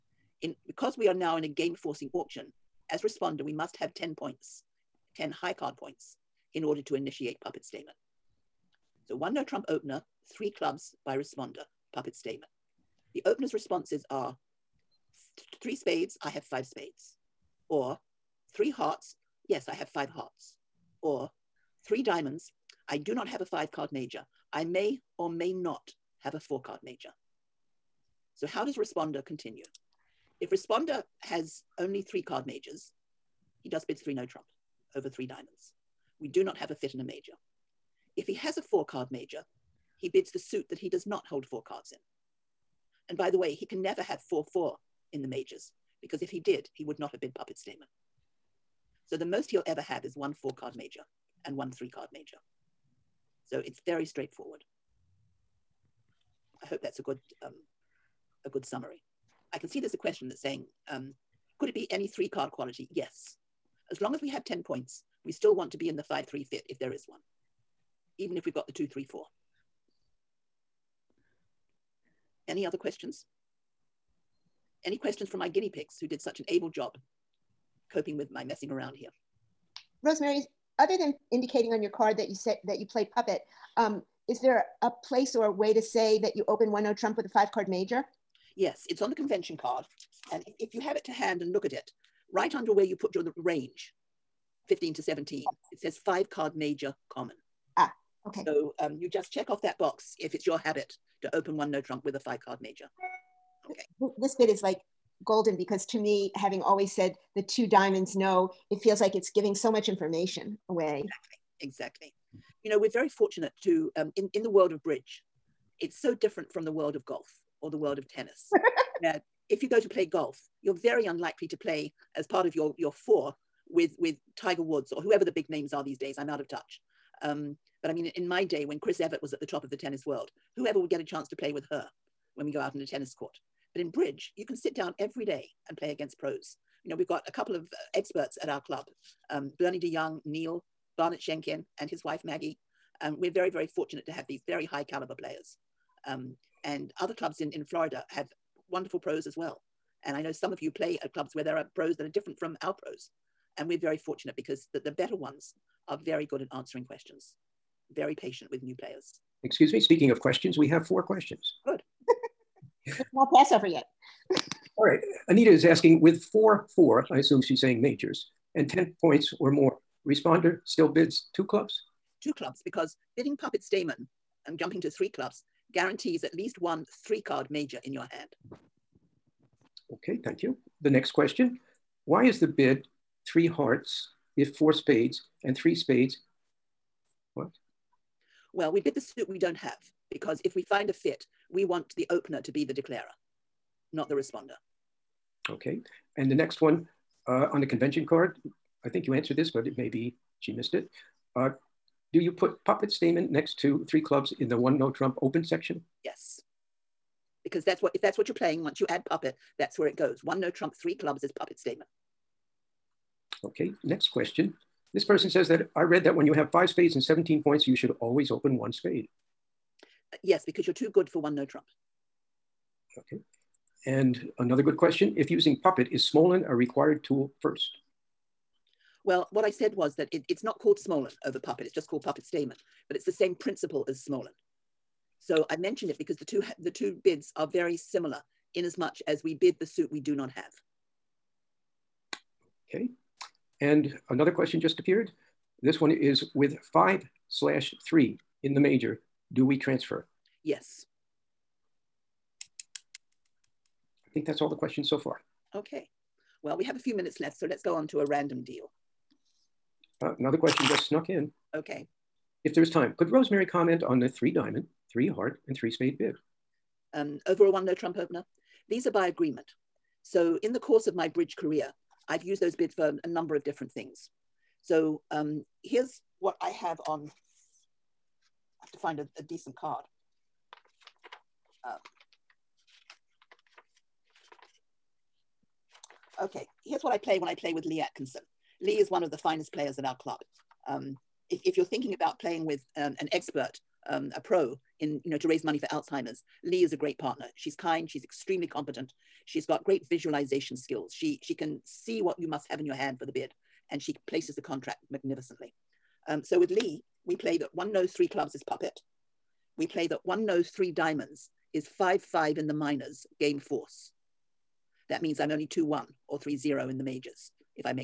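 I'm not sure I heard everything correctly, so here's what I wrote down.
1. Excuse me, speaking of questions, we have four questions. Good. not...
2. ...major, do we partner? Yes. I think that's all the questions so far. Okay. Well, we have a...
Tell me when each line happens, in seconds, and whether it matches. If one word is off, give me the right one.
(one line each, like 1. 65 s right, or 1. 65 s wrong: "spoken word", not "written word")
1. 159 s right
2. 248 s wrong: "transfer", not "partner".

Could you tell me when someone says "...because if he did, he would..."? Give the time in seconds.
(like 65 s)
46 s.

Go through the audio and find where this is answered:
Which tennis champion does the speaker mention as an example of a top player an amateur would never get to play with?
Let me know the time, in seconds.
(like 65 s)
128 s.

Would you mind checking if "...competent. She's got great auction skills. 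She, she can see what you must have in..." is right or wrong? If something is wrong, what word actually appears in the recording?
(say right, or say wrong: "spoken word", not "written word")
wrong: "visualization", not "auction".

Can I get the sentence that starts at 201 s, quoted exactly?
Uh, do you put puppet Stayman next to three clubs in the one no Trump open section?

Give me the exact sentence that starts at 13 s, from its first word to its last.
The opener's responses are three spades, I have five spades, or three hearts.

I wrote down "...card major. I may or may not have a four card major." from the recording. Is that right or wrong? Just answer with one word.
right.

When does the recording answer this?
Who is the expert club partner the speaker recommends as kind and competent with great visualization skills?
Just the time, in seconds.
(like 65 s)
287 s.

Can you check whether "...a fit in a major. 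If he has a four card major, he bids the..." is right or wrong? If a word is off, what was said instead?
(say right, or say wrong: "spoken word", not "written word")
right.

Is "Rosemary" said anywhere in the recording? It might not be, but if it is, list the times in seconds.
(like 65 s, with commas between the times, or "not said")
80 s, 263 s.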